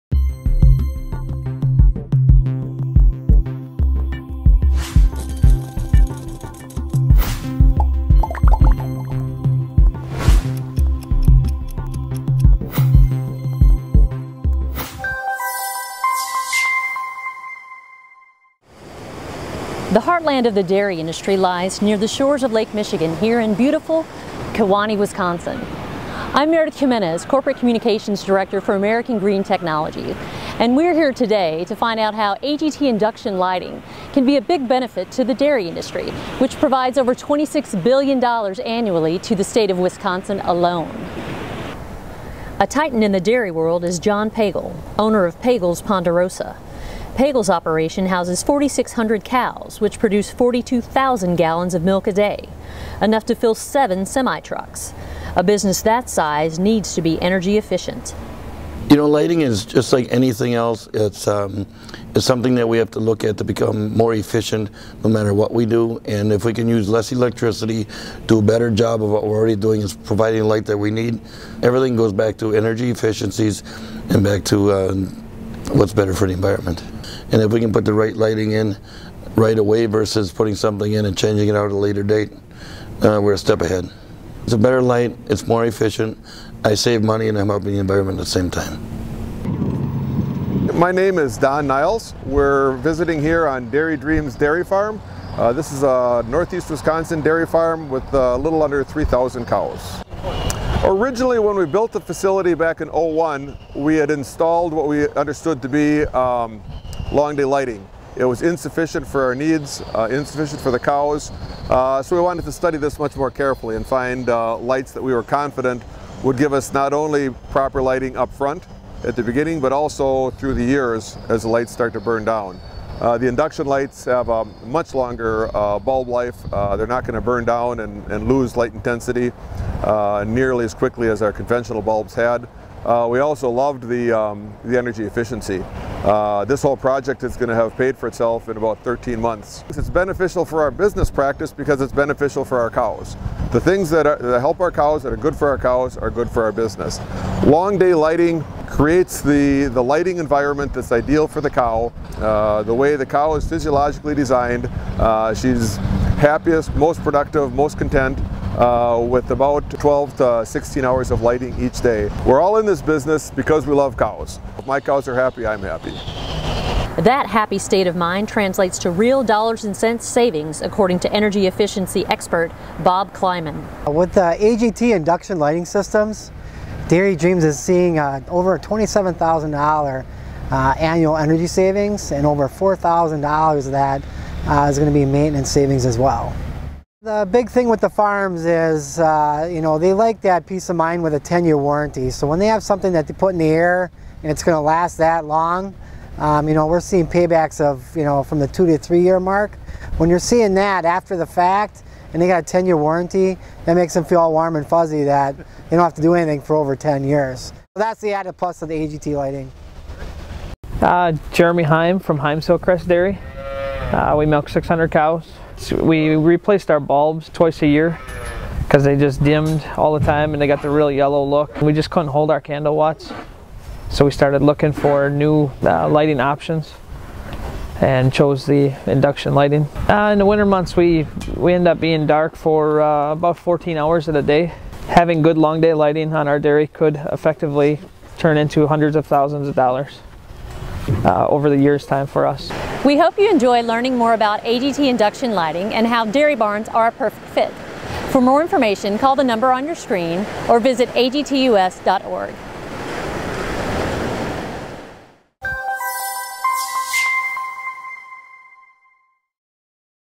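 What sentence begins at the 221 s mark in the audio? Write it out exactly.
We just couldn't hold our candle watts.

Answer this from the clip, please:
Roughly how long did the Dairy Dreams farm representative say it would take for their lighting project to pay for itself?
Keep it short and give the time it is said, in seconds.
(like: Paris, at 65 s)
13 months, at 138 s.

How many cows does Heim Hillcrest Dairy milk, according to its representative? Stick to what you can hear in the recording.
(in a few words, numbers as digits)
600.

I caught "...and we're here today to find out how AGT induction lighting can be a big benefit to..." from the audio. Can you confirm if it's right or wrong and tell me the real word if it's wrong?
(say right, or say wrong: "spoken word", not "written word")
right.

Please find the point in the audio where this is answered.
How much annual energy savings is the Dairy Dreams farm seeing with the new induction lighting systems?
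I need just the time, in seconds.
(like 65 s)
178 s.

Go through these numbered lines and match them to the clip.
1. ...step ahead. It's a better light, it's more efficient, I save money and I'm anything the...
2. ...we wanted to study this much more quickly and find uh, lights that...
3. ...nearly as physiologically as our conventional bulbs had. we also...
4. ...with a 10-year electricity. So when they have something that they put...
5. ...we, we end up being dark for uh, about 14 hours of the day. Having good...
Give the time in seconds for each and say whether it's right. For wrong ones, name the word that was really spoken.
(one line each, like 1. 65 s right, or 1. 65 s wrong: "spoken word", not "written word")
1. 83 s wrong: "helping", not "anything"
2. 112 s wrong: "carefully", not "quickly"
3. 130 s wrong: "quickly", not "physiologically"
4. 191 s wrong: "warranty", not "electricity"
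5. 230 s right.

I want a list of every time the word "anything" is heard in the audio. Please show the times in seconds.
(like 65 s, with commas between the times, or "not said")
60 s, 206 s.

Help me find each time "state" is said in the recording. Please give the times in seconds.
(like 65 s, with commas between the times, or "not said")
39 s, 167 s.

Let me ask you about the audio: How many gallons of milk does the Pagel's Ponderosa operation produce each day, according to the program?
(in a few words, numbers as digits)
42,000.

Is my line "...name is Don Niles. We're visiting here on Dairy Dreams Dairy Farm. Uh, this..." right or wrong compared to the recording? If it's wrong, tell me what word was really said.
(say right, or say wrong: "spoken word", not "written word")
right.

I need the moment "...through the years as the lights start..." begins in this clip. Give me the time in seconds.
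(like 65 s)
120 s.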